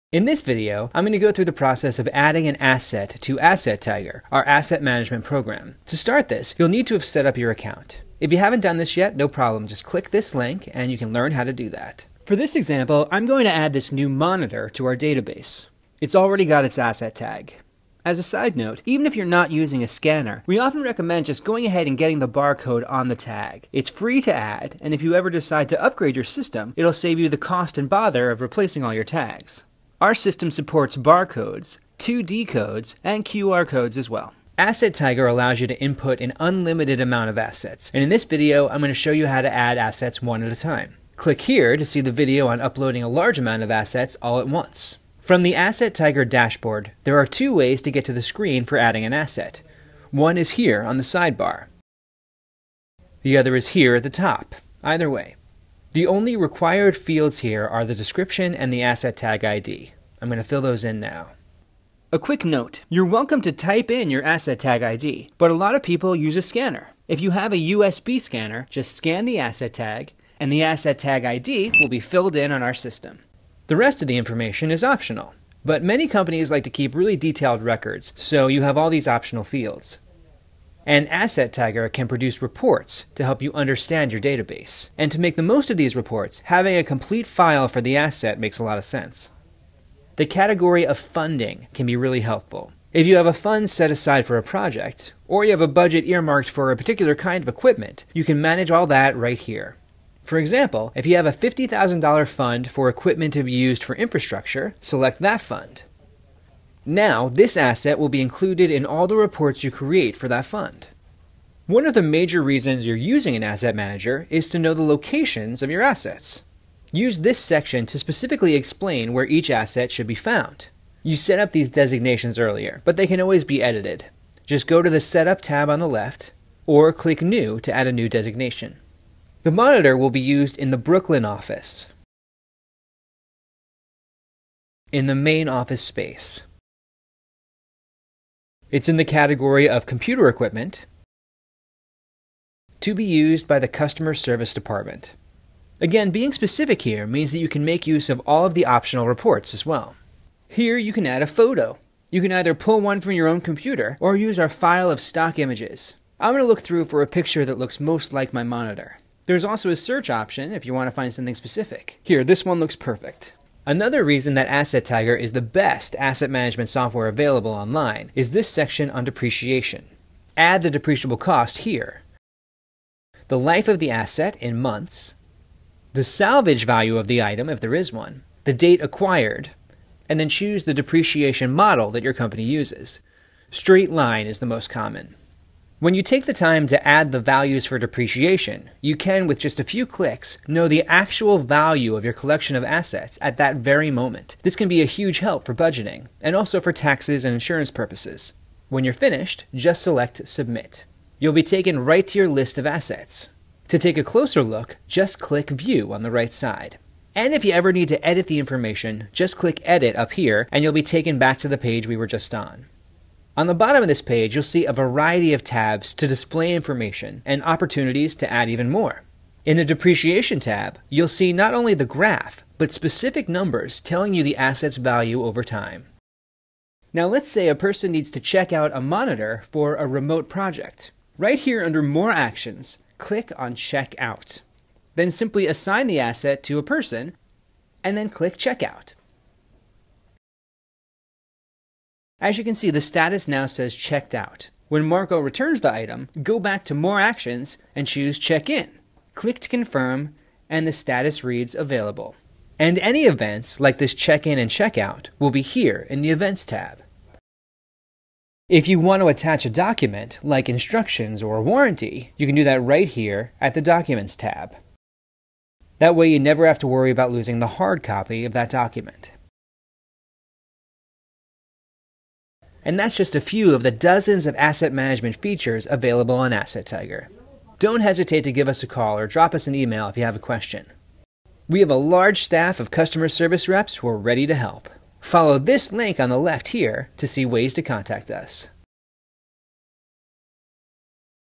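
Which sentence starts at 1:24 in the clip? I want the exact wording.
And to make the most of these reports, having a complete file for the asset makes a lot of sense.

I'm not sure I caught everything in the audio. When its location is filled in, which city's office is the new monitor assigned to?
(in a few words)
Brooklyn.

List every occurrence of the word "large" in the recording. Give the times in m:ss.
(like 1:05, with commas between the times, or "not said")
0:43, 4:41.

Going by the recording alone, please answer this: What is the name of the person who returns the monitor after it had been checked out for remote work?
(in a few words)
Marco.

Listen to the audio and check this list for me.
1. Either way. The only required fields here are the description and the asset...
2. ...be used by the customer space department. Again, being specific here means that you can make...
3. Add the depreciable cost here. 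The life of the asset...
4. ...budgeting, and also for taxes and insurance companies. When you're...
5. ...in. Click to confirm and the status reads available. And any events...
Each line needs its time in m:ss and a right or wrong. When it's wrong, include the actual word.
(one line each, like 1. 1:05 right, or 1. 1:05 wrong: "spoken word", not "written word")
1. 0:54 right
2. 2:22 wrong: "service", not "space"
3. 2:50 right
4. 3:15 wrong: "purposes", not "companies"
5. 4:08 right.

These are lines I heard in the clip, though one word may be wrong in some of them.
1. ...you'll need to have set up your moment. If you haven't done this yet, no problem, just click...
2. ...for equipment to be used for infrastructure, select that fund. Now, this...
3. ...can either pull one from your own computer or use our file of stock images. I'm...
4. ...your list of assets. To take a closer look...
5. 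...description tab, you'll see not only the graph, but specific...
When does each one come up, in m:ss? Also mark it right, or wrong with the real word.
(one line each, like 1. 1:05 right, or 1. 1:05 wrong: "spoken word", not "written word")
1. 0:06 wrong: "account", not "moment"
2. 1:42 right
3. 2:32 right
4. 3:22 right
5. 3:39 wrong: "depreciation", not "description".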